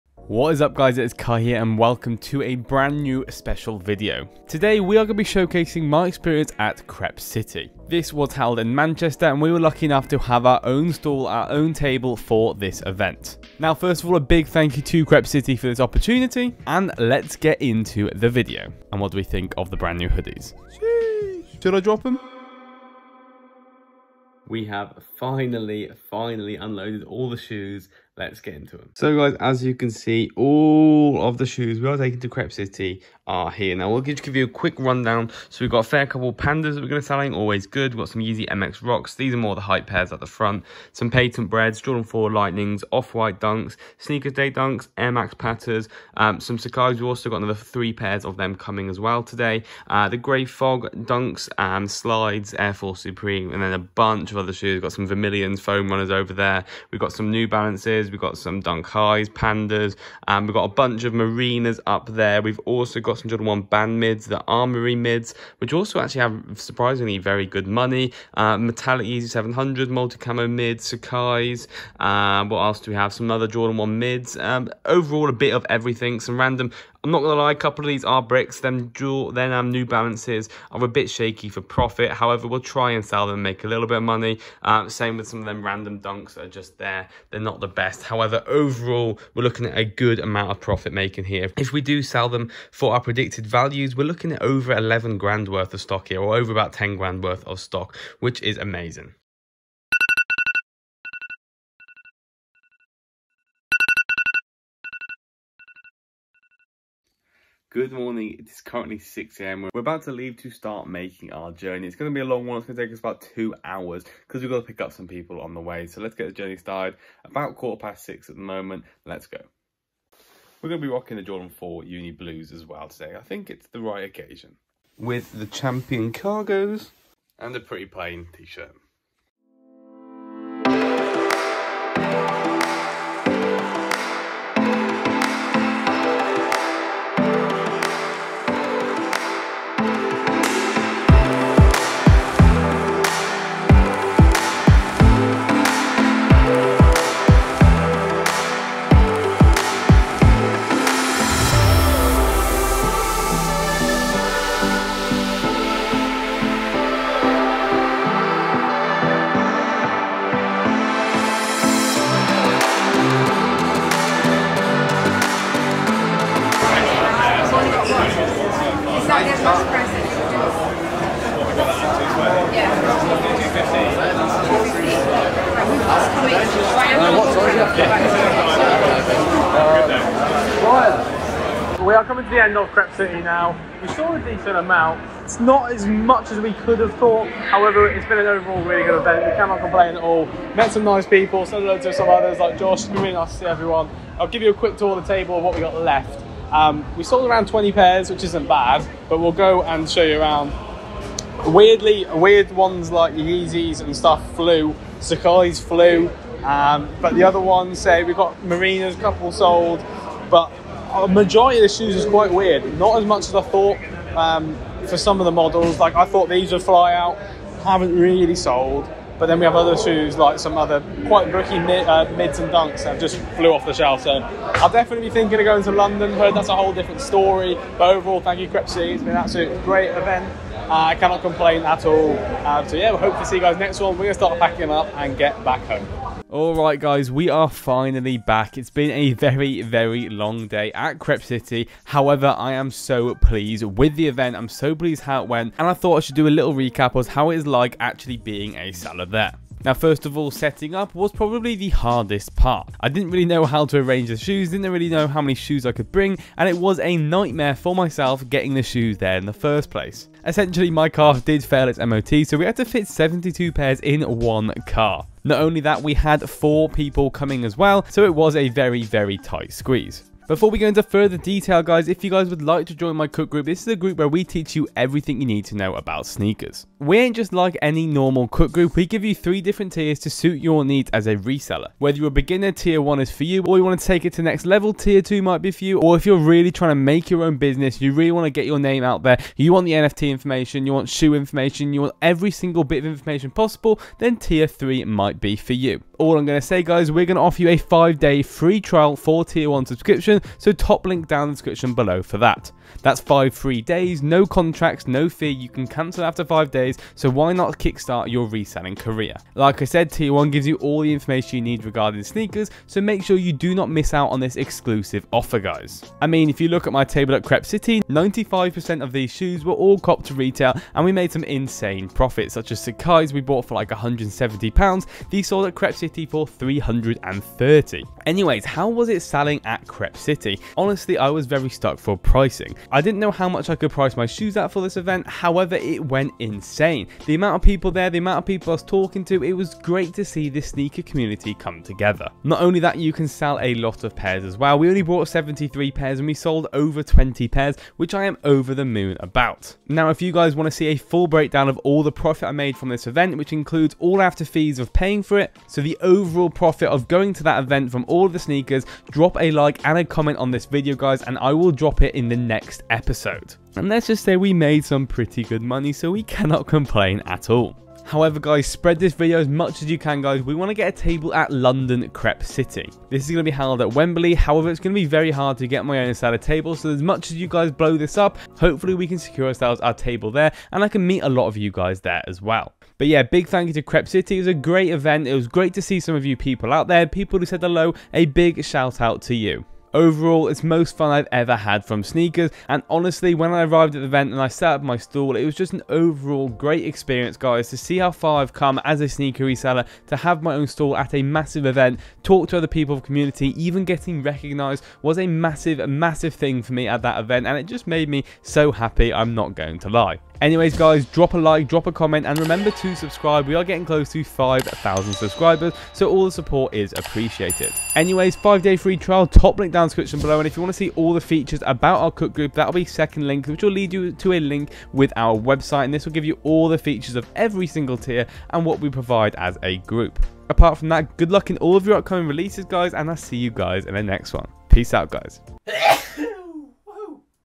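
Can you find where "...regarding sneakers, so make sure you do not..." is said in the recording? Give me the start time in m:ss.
5:11.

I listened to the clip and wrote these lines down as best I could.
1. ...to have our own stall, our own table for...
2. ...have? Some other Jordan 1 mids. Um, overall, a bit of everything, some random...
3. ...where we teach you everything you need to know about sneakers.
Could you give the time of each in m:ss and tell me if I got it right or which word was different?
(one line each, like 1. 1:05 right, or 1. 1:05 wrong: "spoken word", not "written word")
1. 0:10 right
2. 1:12 right
3. 4:33 right.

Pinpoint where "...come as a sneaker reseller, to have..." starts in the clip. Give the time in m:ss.
6:38.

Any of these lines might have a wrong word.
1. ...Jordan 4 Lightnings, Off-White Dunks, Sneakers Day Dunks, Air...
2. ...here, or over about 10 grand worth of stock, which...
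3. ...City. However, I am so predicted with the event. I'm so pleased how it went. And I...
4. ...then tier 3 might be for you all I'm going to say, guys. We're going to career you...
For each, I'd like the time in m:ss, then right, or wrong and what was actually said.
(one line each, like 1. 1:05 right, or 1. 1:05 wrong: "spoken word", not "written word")
1. 0:41 right
2. 1:36 right
3. 4:01 wrong: "pleased", not "predicted"
4. 4:53 wrong: "offer", not "career".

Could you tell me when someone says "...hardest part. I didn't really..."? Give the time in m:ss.
4:11.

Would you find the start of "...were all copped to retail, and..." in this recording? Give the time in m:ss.
5:19.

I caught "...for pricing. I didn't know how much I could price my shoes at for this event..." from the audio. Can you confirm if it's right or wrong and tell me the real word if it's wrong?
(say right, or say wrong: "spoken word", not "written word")
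right.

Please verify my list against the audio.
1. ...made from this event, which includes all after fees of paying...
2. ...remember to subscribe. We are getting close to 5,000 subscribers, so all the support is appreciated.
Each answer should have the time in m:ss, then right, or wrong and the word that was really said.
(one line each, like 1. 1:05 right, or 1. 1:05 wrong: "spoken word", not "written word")
1. 5:52 right
2. 6:52 right.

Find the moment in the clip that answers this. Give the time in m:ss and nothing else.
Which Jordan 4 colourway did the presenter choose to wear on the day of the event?
2:01.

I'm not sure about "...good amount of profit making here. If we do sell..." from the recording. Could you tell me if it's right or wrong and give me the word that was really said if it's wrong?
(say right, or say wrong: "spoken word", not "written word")
right.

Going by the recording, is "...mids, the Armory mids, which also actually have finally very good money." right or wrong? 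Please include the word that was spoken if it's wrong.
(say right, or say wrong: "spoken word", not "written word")
wrong: "surprisingly", not "finally".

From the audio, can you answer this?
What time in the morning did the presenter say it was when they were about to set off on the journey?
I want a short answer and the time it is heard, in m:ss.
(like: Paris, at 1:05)
6am, at 1:48.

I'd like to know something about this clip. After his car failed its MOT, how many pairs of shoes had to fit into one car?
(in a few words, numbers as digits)
72.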